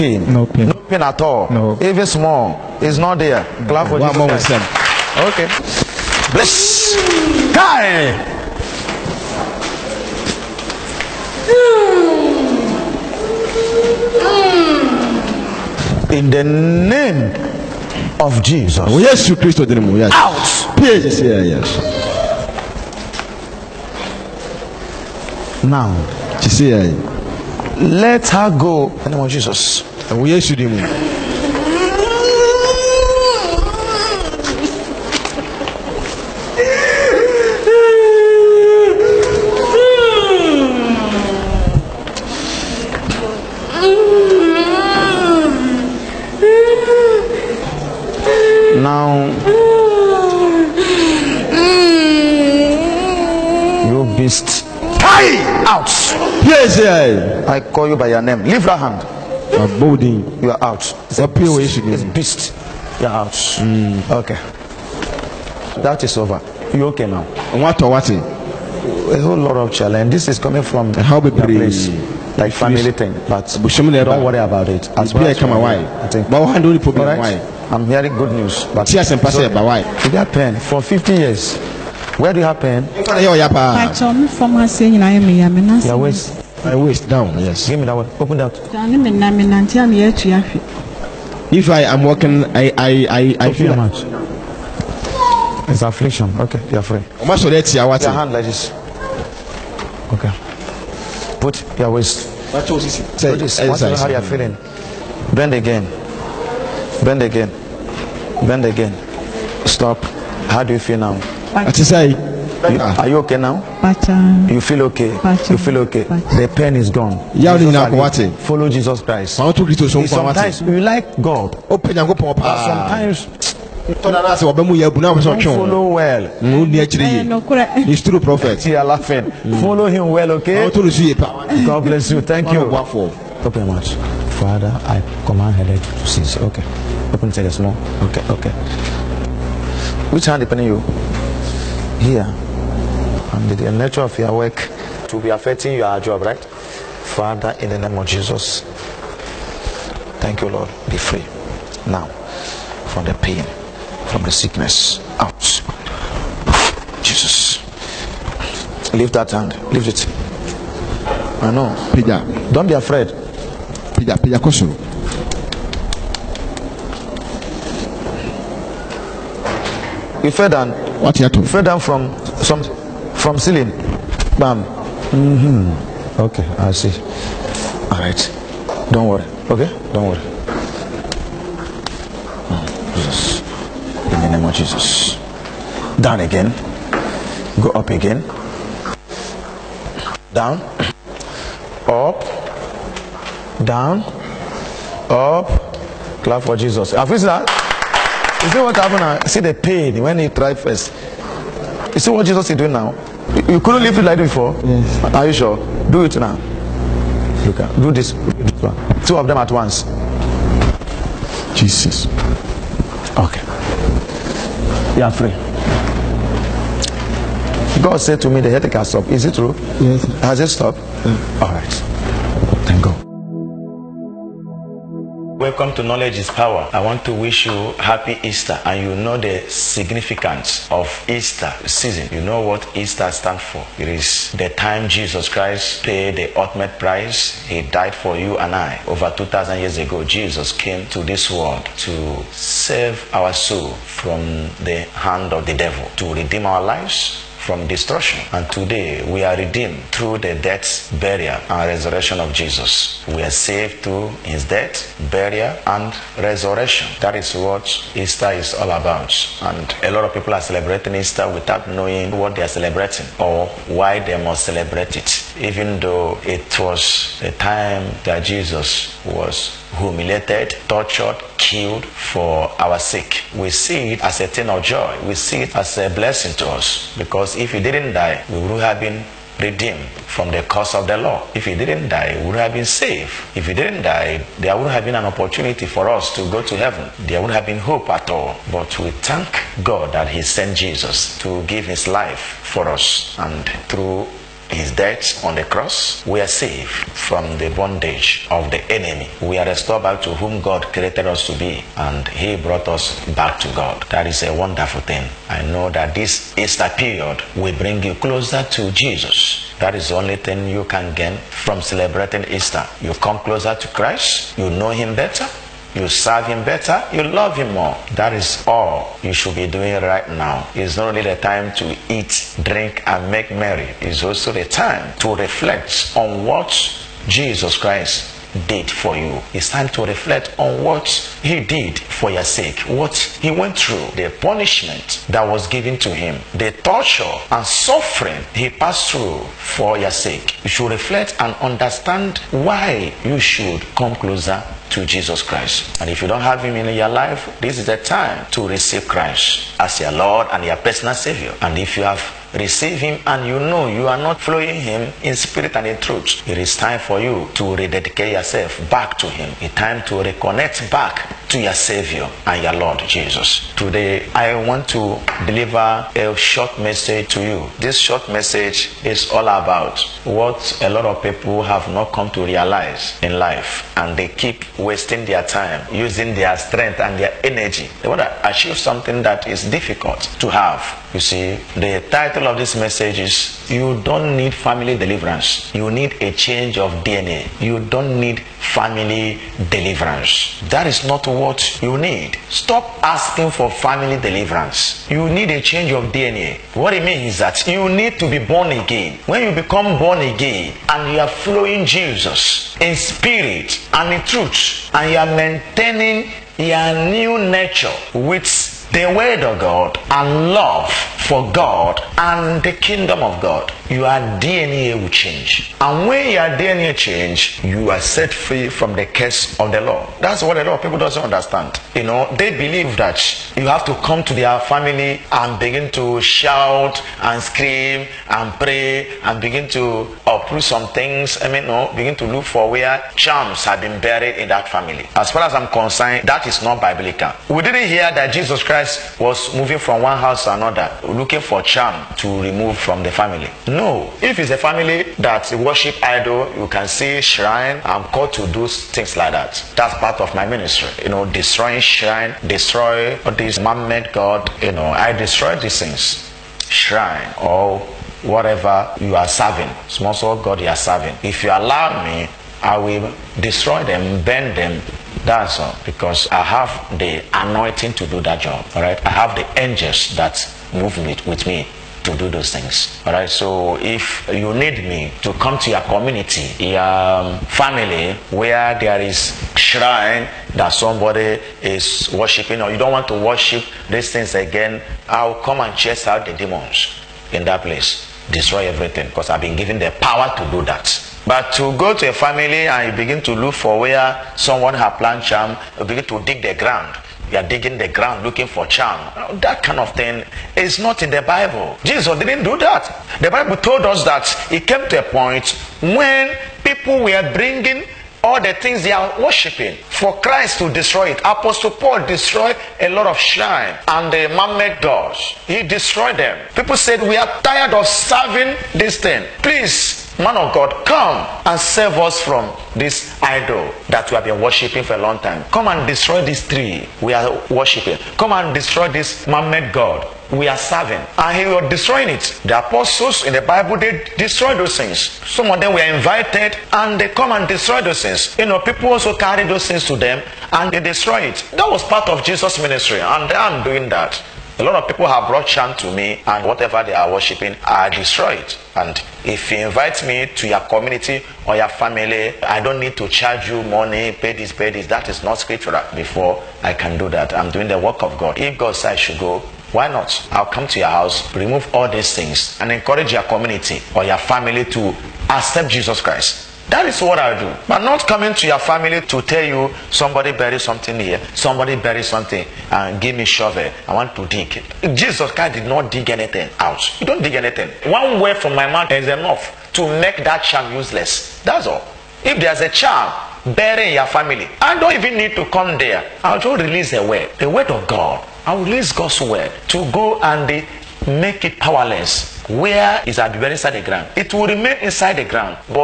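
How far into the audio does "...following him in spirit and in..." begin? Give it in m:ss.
5:54.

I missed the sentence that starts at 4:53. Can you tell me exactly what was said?
And through his death on the cross, we are saved from the bondage of the enemy.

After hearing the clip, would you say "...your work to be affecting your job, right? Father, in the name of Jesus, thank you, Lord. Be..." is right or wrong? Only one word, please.
right.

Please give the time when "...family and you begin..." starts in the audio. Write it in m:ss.
8:11.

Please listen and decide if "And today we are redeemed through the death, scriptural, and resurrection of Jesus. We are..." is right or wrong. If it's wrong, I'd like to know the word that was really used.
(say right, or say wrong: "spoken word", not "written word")
wrong: "burial", not "scriptural".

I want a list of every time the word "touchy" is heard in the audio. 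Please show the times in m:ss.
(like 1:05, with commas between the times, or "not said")
not said.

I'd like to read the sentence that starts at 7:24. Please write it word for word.
If it's a family that worship idol, you can see shrine.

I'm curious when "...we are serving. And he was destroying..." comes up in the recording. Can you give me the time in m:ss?
8:50.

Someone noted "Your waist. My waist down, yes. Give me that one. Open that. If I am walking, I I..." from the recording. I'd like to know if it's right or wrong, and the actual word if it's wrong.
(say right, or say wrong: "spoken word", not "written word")
right.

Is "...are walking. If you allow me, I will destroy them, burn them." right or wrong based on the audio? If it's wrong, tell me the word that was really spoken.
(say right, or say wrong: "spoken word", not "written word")
wrong: "serving", not "walking".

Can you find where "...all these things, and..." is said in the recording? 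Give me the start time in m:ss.
9:21.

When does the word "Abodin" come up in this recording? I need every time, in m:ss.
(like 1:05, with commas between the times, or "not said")
0:59.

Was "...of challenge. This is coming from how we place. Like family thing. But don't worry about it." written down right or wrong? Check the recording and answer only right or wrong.
right.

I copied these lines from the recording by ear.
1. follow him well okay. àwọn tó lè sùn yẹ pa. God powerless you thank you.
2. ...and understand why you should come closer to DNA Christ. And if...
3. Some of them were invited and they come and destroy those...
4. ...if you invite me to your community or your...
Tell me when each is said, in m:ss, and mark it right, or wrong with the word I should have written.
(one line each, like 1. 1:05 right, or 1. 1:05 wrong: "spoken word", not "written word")
1. 2:09 wrong: "bless", not "powerless"
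2. 5:41 wrong: "Jesus", not "DNA"
3. 8:55 right
4. 9:09 right.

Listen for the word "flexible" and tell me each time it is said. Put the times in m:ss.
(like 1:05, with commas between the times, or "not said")
not said.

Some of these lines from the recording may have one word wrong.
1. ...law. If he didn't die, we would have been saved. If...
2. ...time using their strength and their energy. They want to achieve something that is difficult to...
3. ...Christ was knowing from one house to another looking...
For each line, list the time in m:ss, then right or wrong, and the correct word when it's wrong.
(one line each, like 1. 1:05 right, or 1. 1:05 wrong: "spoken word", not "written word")
1. 4:40 right
2. 6:15 right
3. 7:18 wrong: "moving", not "knowing".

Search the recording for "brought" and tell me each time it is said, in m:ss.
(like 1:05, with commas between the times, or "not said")
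5:02, 9:05.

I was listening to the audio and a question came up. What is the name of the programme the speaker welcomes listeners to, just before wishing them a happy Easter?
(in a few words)
Knowledge is Power.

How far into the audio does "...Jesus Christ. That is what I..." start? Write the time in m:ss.
9:25.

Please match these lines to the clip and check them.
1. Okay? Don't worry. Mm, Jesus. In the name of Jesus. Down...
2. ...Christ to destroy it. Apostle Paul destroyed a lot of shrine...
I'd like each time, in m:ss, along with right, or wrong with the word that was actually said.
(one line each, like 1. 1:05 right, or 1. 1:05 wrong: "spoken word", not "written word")
1. 2:59 right
2. 8:30 right.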